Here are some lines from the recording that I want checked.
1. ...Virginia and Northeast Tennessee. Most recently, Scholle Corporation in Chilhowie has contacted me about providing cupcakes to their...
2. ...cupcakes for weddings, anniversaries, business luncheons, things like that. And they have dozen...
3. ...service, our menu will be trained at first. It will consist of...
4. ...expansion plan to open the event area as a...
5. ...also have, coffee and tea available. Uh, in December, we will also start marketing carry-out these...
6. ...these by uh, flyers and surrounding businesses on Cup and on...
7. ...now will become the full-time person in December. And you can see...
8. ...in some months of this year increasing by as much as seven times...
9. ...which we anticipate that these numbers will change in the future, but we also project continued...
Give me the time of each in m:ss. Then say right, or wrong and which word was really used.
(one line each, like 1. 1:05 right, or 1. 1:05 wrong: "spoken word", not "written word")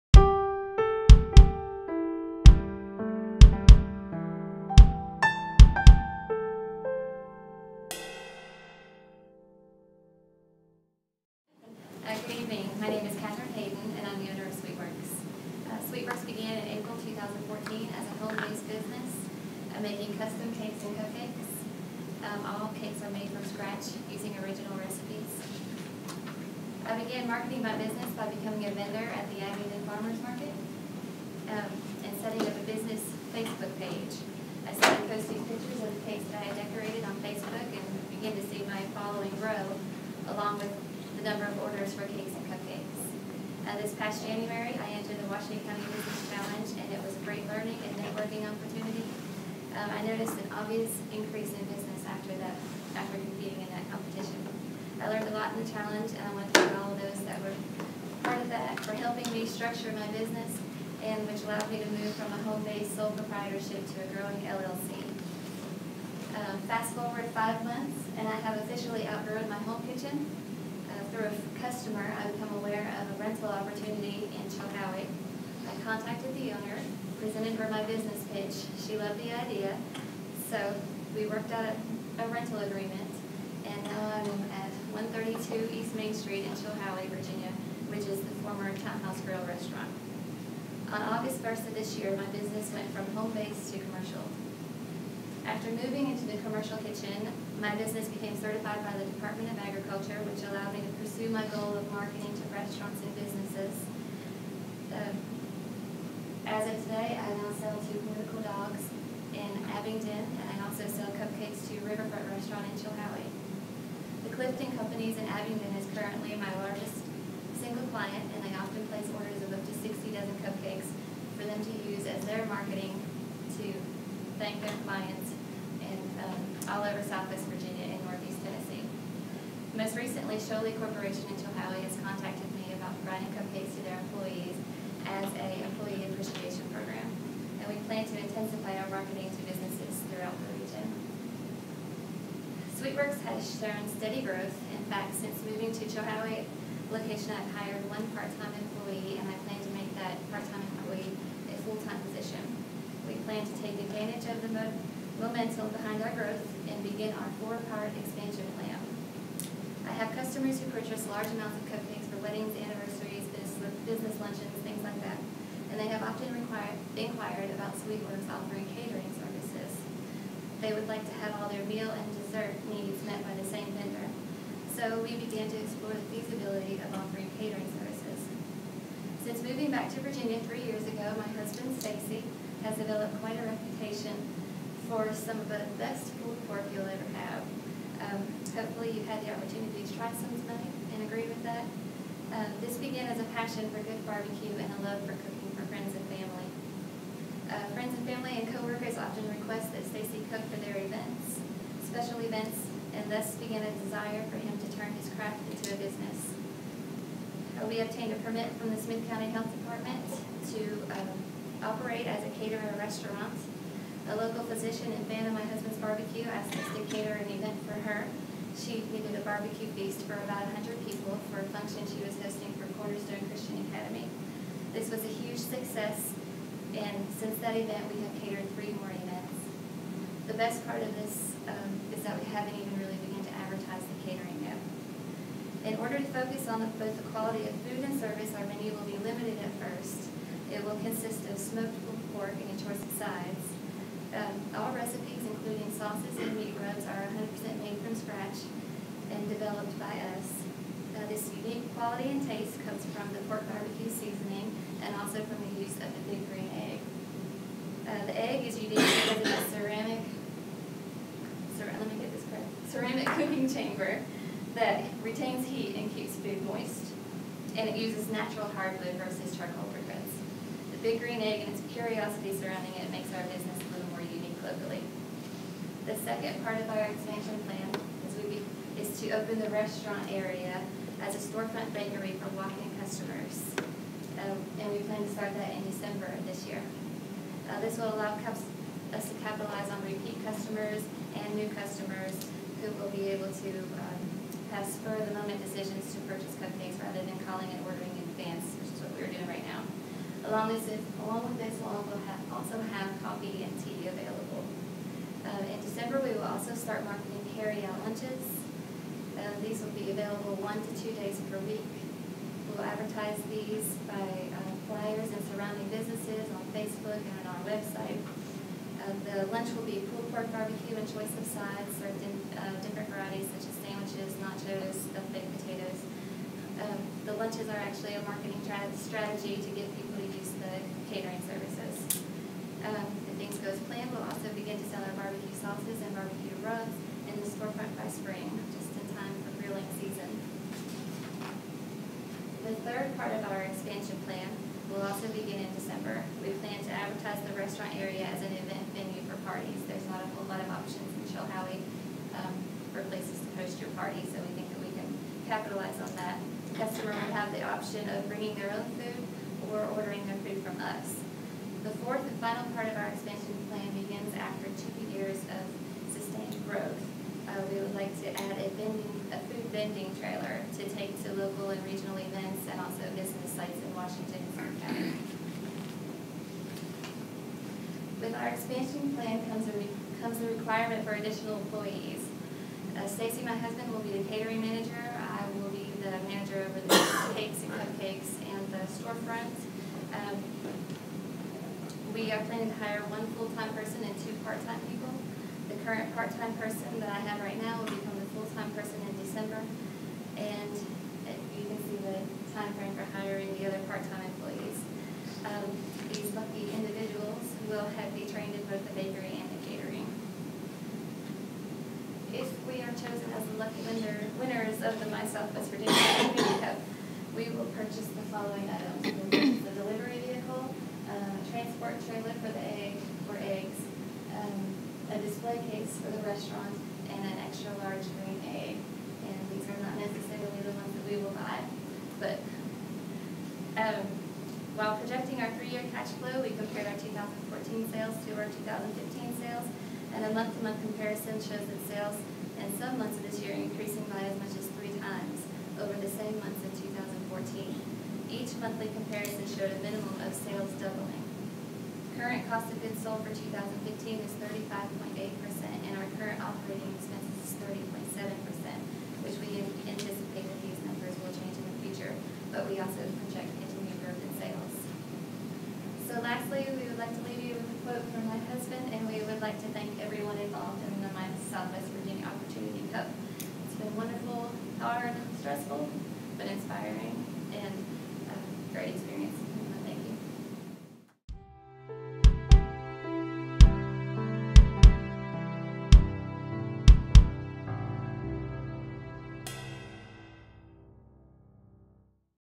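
1. 2:07 right
2. 2:41 wrong: "often", not "dozen"
3. 3:57 wrong: "limited", not "trained"
4. 4:36 wrong: "restaurant", not "event"
5. 5:02 right
6. 5:13 wrong: "Facebook", not "Cup"
7. 6:37 right
8. 7:22 wrong: "three", not "seven"
9. 7:39 right.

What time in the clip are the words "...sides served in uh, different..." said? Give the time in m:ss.
5:21.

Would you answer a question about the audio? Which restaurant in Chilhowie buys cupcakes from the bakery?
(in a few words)
Riverfront Restaurant.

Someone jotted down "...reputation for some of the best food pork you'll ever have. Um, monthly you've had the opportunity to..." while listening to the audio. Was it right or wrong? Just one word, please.
wrong.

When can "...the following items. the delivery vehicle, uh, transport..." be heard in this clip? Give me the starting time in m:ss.
6:57.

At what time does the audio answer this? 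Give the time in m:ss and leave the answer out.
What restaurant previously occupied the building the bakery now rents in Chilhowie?
1:28.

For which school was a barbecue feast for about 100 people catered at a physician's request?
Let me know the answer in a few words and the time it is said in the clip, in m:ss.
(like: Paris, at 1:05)
Cornerstone Christian Academy, at 3:42.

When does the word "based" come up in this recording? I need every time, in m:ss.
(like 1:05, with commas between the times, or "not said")
0:18, 1:02, 1:33.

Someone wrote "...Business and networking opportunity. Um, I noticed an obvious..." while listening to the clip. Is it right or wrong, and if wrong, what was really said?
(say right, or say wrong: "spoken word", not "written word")
right.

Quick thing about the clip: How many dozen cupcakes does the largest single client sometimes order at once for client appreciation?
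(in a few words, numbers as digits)
60.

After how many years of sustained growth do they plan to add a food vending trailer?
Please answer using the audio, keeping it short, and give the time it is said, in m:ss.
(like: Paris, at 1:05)
2, at 6:04.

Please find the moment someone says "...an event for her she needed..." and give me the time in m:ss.
3:37.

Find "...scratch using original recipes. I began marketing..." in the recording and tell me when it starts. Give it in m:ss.
0:23.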